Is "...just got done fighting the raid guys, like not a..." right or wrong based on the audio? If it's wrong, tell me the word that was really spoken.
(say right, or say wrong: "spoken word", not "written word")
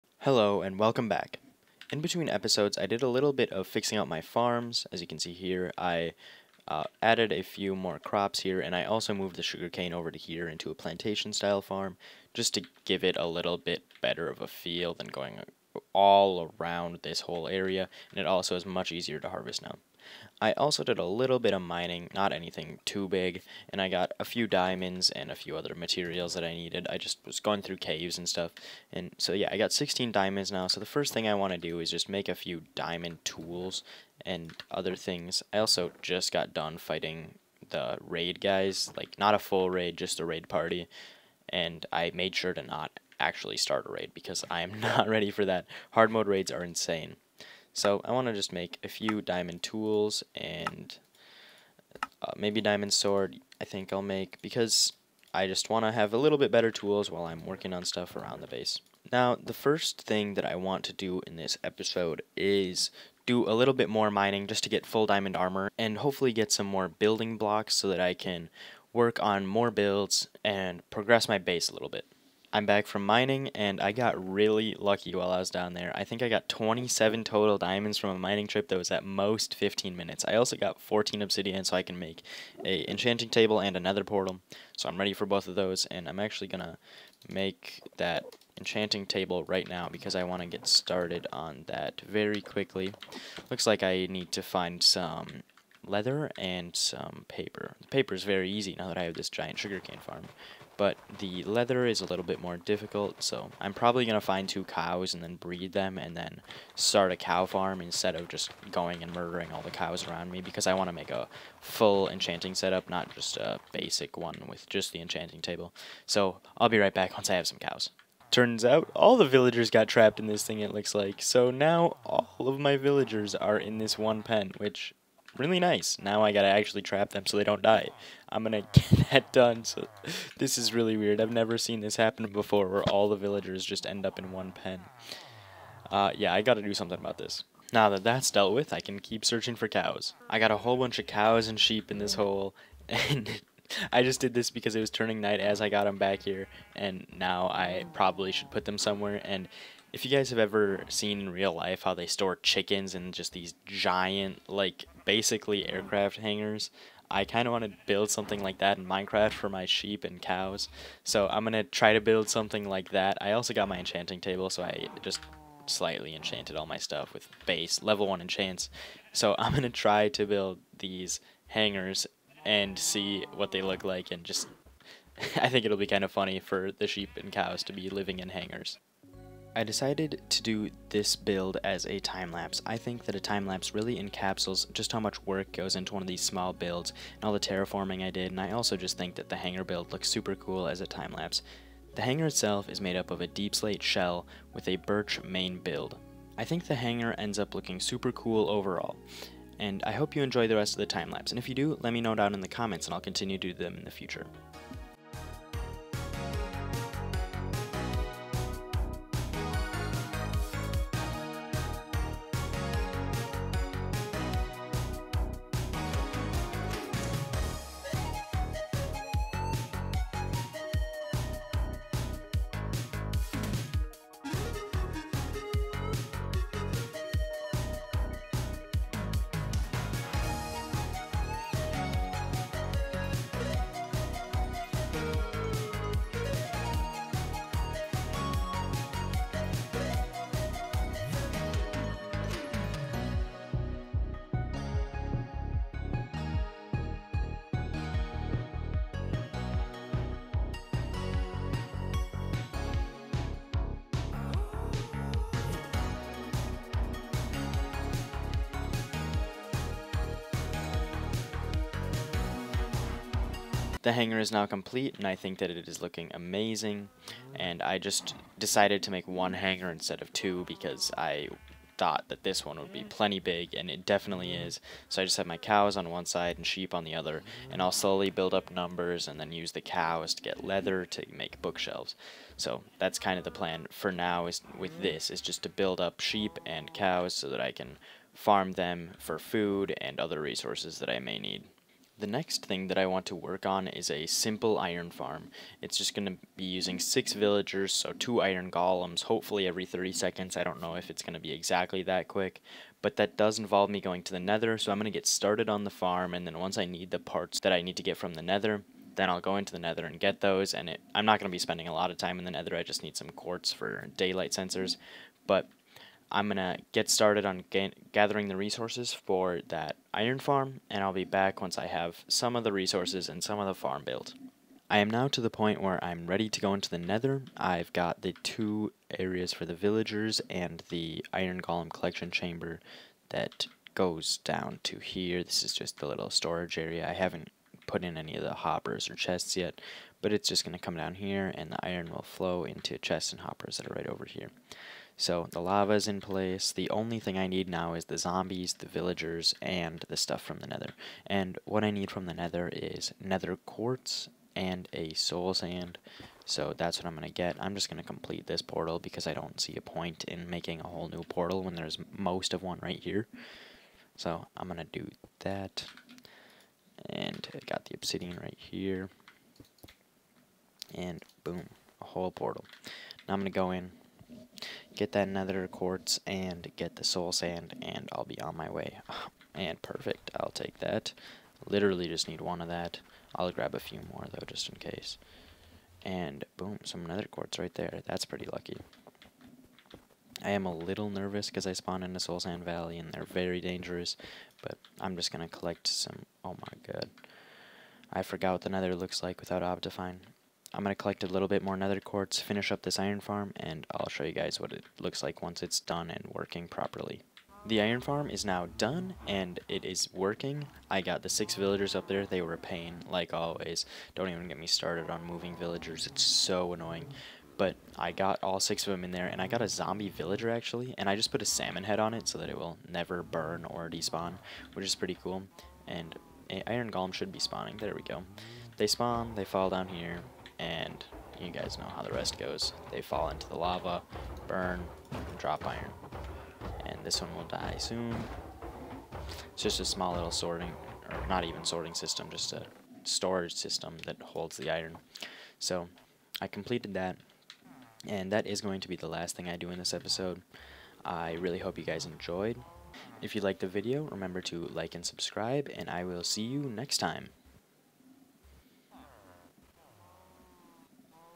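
right.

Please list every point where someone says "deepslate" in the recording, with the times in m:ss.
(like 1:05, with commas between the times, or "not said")
3:13.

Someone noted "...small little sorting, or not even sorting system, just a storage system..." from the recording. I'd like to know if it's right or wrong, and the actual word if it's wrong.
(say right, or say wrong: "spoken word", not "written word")
right.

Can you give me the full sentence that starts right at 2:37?
I kind of want to build something like that in Minecraft for my sheep and cows.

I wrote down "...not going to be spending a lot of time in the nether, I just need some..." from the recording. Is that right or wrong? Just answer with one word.
right.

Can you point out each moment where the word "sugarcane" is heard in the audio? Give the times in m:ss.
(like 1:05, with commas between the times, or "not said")
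0:09, 1:39.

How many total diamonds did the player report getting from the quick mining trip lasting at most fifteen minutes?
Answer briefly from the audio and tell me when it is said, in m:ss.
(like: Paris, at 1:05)
27, at 1:16.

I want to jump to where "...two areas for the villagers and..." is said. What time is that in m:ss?
5:28.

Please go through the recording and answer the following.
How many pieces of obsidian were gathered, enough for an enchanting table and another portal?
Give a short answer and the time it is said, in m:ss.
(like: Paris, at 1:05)
14, at 1:20.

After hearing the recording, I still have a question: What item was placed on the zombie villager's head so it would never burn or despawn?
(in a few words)
A salmon.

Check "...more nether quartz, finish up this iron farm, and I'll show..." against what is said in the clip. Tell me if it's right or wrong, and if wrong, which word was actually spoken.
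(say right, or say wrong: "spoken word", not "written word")
right.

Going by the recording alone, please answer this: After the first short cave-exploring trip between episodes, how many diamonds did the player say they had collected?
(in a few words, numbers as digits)
16.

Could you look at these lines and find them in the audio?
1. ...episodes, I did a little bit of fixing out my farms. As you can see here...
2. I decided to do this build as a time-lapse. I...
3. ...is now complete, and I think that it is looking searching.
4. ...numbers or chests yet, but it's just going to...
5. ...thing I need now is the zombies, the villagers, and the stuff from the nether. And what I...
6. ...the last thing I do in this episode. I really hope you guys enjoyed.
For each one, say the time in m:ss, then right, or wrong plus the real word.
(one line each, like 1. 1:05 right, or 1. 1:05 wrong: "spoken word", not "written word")
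1. 0:02 right
2. 2:59 right
3. 4:24 wrong: "amazing", not "searching"
4. 5:38 wrong: "hoppers", not "numbers"
5. 5:46 right
6. 7:28 right.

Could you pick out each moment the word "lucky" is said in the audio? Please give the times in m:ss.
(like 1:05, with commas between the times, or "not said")
1:14, 6:28.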